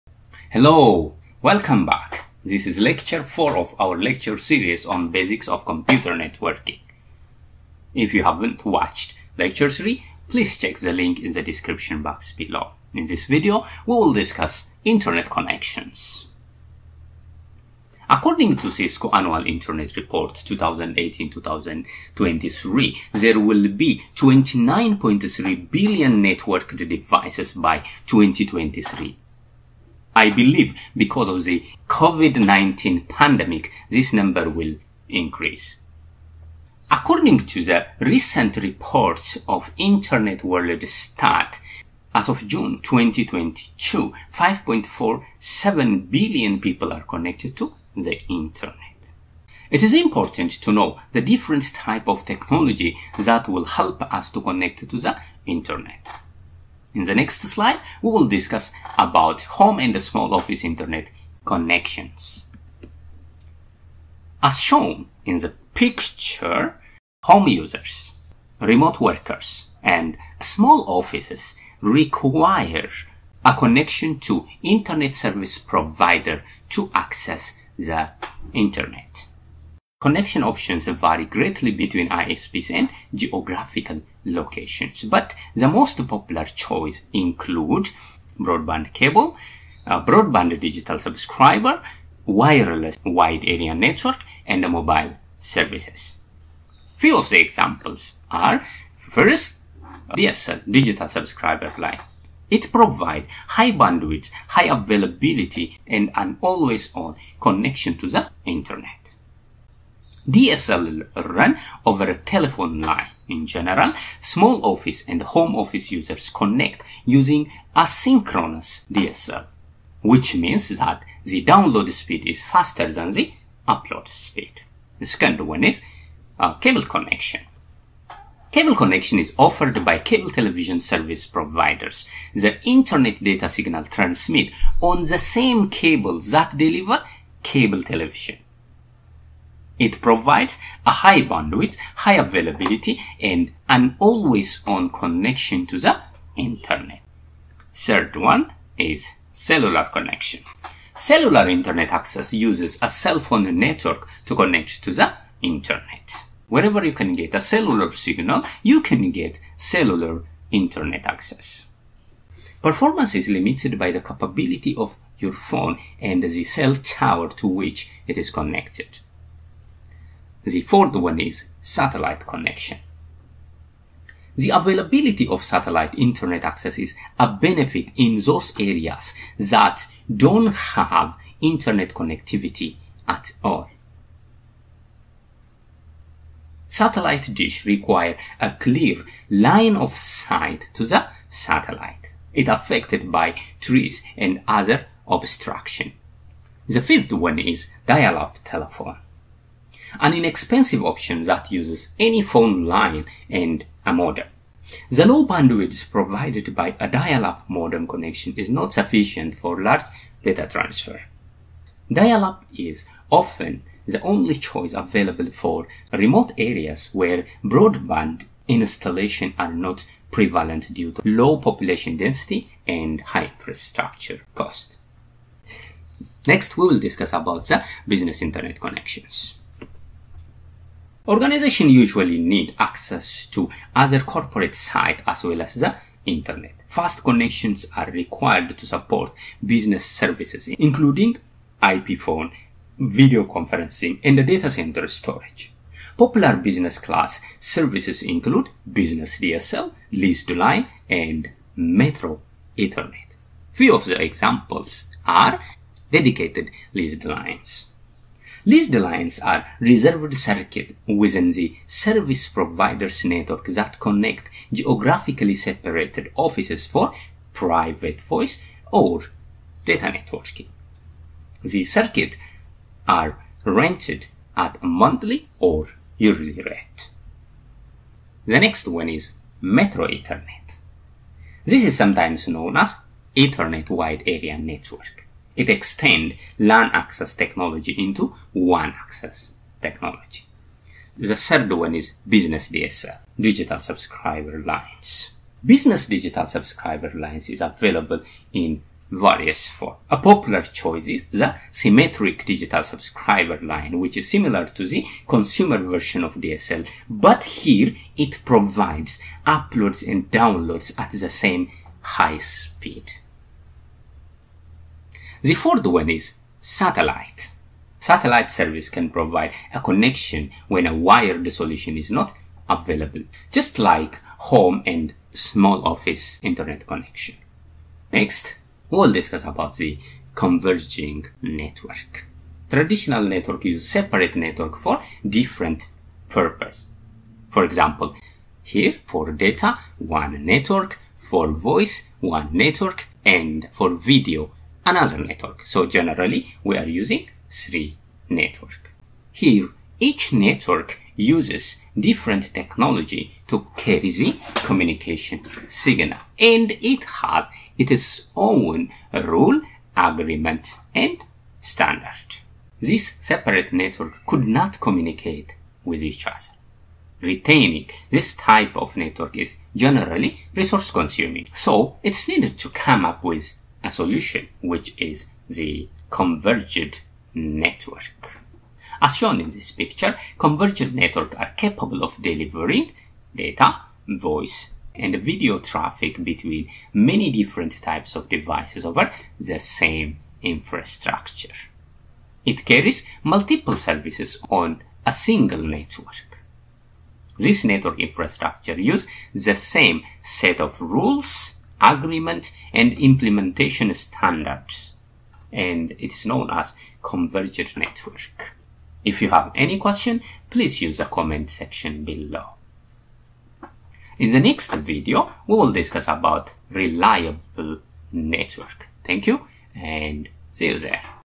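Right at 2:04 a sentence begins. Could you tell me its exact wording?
The second one is a uh, cable connection.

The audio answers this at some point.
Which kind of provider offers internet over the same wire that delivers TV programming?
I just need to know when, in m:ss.
2:09.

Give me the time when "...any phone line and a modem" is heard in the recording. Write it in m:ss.
3:21.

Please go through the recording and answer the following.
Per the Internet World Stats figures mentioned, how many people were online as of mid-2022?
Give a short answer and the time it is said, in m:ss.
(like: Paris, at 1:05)
5.47 billion, at 0:44.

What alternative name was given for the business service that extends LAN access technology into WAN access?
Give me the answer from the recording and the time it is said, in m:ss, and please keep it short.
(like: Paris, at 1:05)
Ethernet Wide Area Network, at 4:43.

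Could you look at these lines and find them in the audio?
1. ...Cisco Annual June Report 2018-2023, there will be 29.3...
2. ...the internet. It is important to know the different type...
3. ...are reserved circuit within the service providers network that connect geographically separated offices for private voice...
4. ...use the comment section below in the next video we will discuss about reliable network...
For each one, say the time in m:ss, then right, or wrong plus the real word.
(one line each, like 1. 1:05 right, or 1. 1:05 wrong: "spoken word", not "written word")
1. 0:18 wrong: "Internet", not "June"
2. 0:47 right
3. 4:19 right
4. 6:50 right.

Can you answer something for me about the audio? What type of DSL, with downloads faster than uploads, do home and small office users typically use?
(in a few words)
asynchronous DSL.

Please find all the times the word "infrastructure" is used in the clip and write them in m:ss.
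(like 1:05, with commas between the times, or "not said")
3:43, 6:30, 6:37.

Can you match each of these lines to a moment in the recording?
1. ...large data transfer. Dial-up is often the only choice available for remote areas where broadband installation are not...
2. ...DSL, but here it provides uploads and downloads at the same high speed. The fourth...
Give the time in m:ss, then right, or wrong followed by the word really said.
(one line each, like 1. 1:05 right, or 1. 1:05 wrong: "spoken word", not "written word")
1. 3:29 right
2. 5:06 right.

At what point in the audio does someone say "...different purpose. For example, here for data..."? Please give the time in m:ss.
5:35.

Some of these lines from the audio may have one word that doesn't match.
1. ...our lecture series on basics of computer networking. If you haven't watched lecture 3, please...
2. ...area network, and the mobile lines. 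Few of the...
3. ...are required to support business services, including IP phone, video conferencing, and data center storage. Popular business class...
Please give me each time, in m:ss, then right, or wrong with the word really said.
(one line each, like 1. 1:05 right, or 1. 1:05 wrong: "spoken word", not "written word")
1. 0:03 right
2. 1:33 wrong: "services", not "lines"
3. 3:57 right.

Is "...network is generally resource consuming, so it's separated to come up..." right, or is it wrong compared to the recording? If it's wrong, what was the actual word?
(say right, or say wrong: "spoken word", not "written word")
wrong: "needed", not "separated".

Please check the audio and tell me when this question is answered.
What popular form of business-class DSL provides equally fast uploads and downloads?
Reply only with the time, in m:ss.
5:01.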